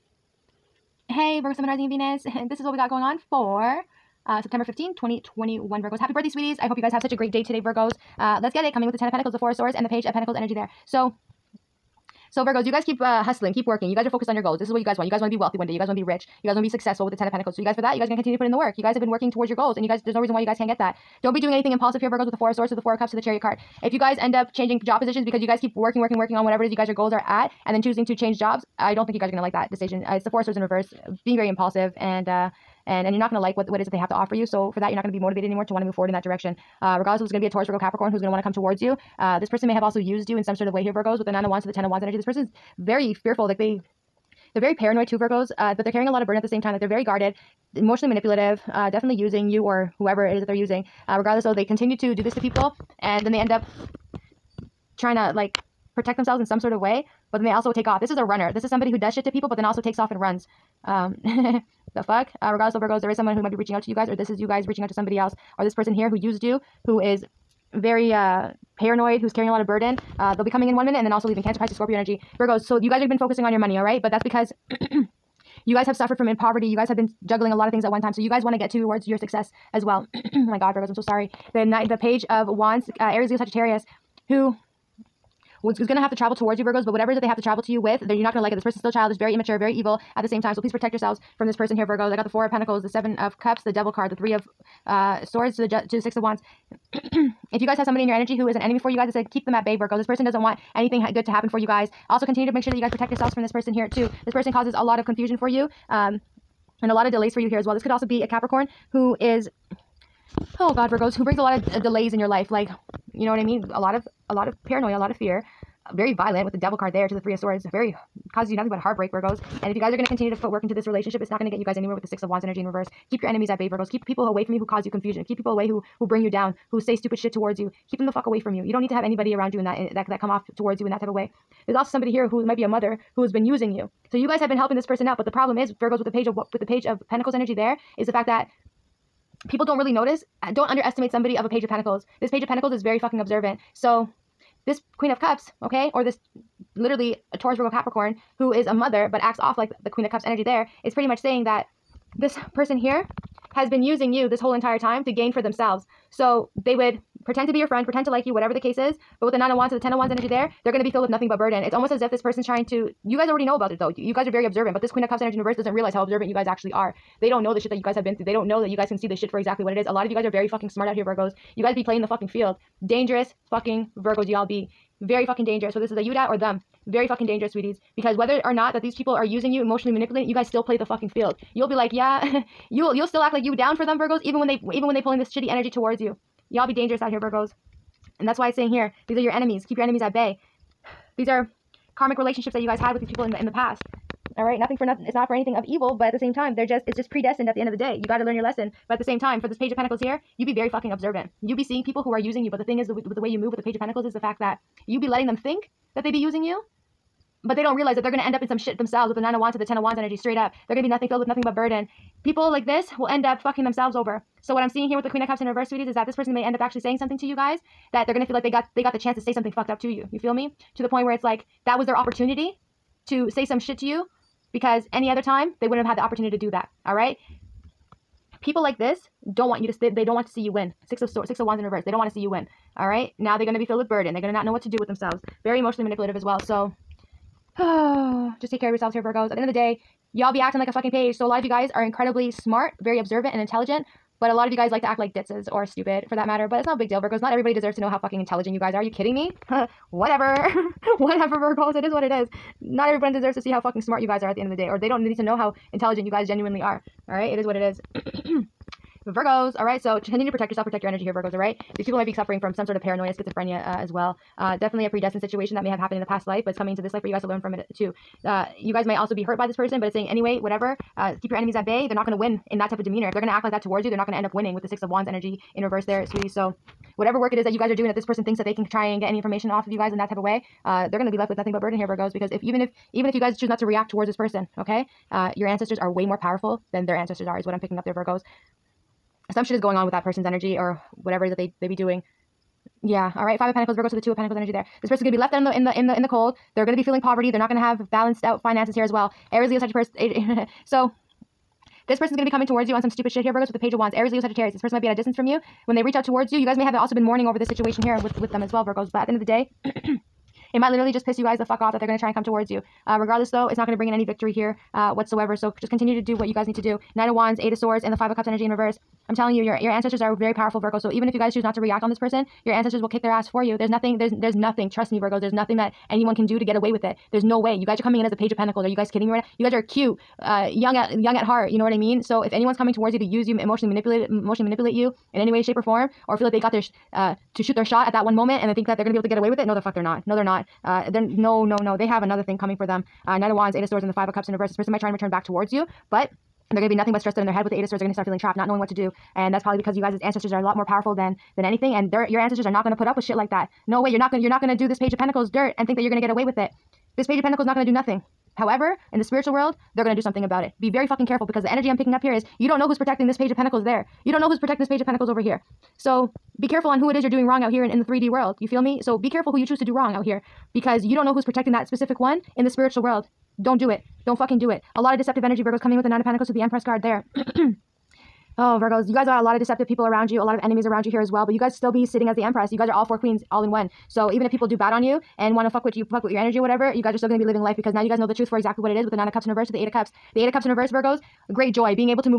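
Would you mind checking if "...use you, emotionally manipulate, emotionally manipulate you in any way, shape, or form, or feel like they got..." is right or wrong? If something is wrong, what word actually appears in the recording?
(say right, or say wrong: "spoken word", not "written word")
right.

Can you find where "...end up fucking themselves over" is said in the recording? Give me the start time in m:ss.
3:33.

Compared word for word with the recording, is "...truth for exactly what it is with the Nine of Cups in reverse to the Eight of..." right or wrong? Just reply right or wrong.
right.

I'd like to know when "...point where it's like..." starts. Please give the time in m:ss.
3:40.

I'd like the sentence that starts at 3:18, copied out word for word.
You got to learn your lesson, but at the same time, for this page of pentacles here, you be very fucking observant.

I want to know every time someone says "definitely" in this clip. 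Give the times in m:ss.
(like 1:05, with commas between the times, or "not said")
0:48, 4:24.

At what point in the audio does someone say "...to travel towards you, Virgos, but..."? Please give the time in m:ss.
1:26.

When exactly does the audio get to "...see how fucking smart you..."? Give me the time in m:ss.
4:13.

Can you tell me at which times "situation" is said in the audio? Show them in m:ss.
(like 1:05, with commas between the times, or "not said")
4:25, 5:07.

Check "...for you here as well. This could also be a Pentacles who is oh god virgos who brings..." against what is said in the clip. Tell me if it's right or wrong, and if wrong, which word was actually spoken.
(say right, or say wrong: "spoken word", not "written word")
wrong: "Capricorn", not "Pentacles".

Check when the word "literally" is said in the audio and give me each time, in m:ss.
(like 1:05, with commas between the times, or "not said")
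2:26, 5:10.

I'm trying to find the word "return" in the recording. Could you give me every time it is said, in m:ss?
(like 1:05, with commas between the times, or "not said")
5:44.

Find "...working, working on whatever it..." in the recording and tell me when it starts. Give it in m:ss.
0:25.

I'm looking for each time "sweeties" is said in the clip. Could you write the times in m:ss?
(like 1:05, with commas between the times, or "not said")
0:06, 2:57, 3:35, 4:36.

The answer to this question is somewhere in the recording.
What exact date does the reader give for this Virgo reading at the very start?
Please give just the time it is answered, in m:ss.
0:04.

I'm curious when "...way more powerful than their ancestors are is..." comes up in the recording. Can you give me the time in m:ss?
4:45.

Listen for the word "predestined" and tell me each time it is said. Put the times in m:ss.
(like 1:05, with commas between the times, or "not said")
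3:17, 4:24.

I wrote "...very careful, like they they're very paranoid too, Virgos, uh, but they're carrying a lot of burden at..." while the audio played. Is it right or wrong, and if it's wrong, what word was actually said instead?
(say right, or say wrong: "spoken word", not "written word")
wrong: "fearful", not "careful".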